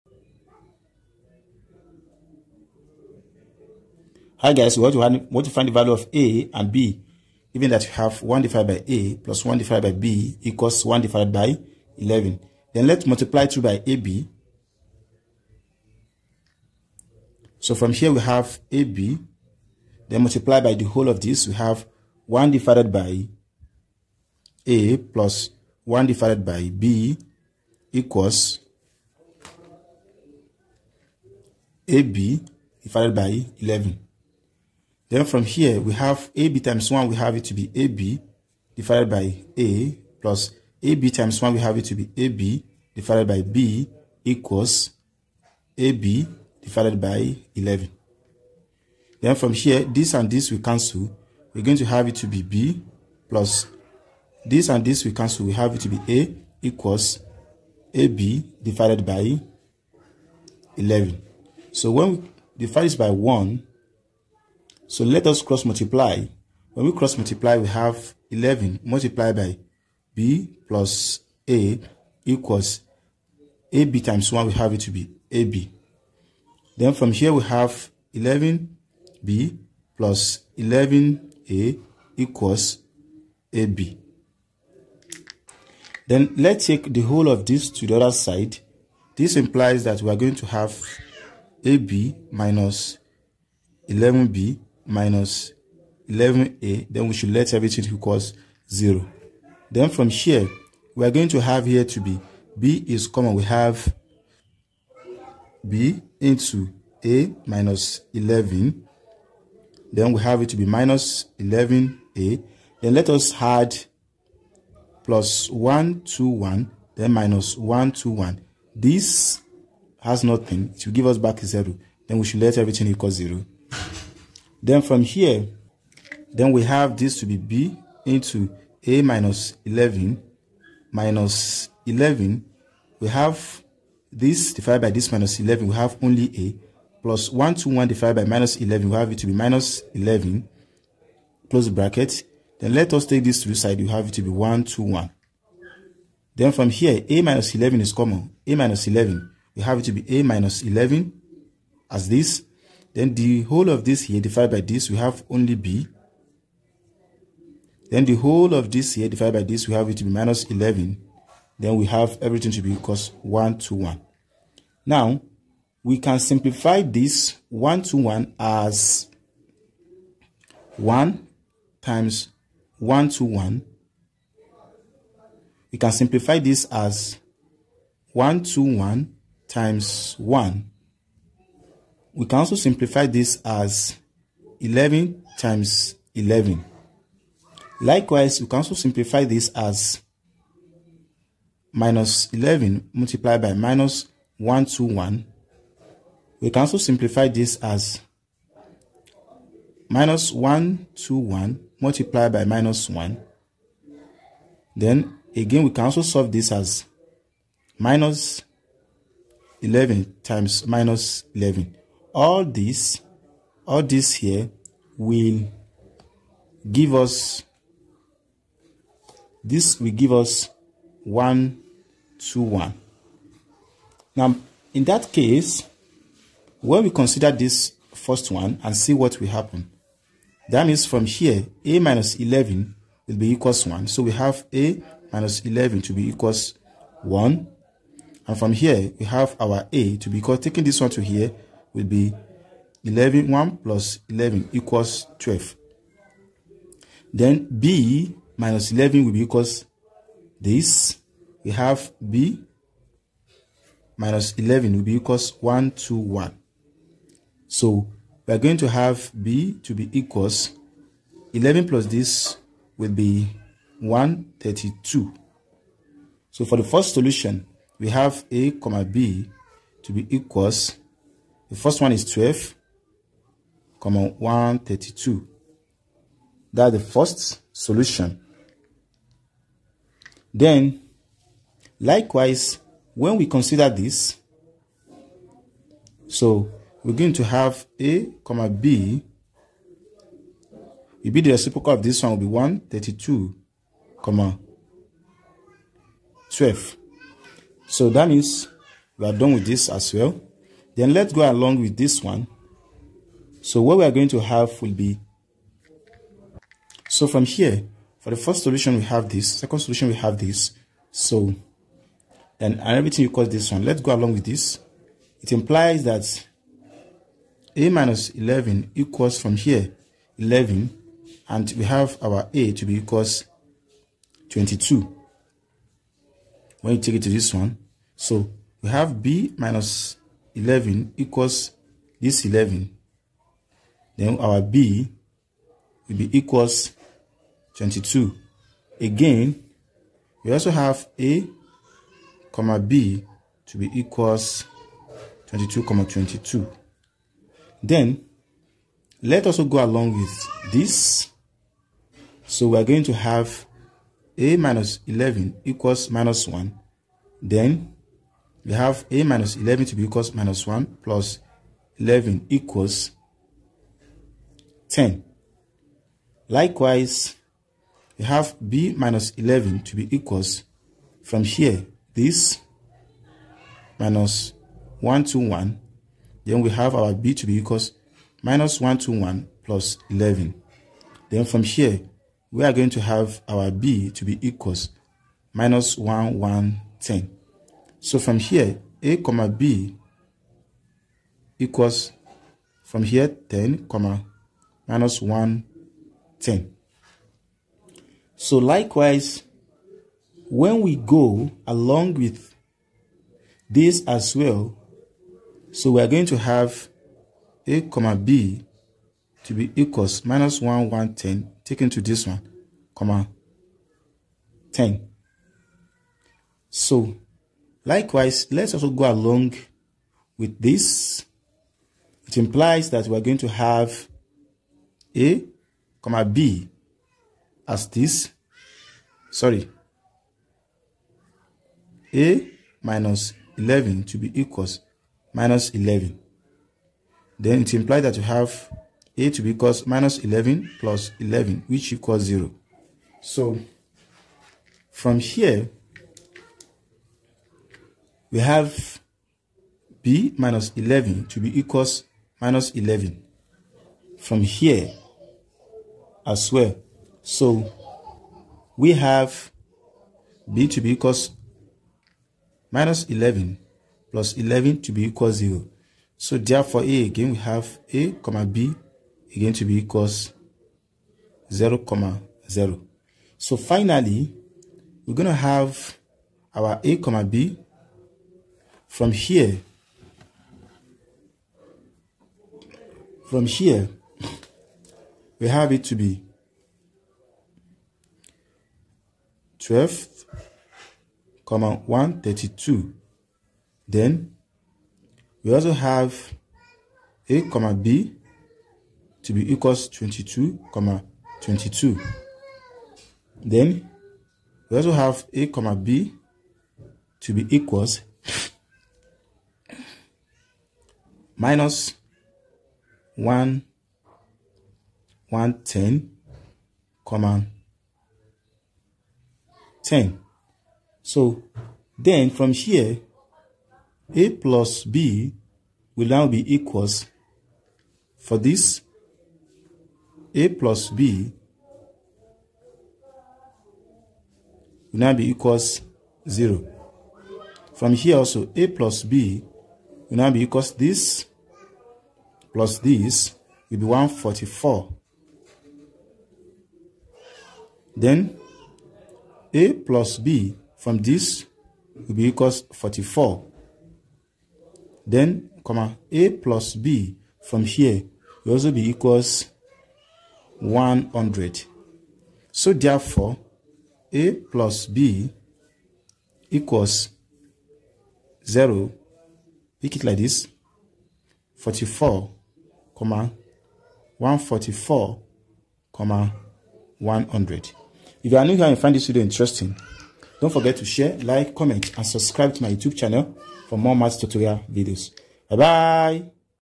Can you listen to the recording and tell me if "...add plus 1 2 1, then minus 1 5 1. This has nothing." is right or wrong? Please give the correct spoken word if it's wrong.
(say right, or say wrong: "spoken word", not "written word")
wrong: "2", not "5".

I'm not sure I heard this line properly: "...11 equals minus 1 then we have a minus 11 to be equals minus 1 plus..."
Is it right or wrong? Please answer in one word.
right.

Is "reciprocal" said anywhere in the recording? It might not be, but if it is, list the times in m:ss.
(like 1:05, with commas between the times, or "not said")
4:51.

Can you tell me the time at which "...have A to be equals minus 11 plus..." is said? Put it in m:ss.
7:18.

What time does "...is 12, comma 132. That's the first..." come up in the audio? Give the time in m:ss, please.
4:31.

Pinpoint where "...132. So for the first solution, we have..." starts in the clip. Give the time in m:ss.
4:23.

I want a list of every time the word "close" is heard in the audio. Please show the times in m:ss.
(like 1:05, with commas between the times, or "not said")
2:21.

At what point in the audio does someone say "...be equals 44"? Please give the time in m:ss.
9:11.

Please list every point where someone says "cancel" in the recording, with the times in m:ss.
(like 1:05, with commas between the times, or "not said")
0:50, 0:55.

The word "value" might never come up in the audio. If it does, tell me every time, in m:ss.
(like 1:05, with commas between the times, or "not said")
0:05.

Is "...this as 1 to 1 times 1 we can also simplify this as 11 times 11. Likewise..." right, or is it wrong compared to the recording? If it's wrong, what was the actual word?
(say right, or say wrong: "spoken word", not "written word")
right.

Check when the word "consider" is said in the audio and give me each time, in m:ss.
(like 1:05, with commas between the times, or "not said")
3:46, 4:43.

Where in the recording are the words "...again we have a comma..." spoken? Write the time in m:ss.
7:46.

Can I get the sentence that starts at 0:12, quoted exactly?
Then let's multiply 2 by AB.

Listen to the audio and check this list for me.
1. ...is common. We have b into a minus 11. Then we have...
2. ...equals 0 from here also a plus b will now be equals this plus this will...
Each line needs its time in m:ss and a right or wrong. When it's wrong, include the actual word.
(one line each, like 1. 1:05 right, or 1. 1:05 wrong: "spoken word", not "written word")
1. 1:42 right
2. 8:55 right.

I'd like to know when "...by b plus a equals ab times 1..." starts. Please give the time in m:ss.
1:09.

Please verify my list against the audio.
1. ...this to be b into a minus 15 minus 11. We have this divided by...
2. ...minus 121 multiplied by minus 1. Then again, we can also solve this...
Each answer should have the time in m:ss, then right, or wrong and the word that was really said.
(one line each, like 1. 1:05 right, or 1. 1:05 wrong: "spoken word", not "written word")
1. 2:06 wrong: "11", not "15"
2. 3:19 right.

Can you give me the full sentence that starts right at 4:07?
Then B minus 11 will be equals this.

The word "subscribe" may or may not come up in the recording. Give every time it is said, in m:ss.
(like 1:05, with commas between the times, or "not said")
9:41.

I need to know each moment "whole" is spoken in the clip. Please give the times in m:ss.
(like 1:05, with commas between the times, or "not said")
0:20, 1:26, 2:33, 2:38.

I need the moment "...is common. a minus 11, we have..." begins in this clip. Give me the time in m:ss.
2:27.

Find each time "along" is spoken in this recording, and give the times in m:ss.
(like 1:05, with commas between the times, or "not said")
5:01, 5:13, 5:49, 6:41, 6:58.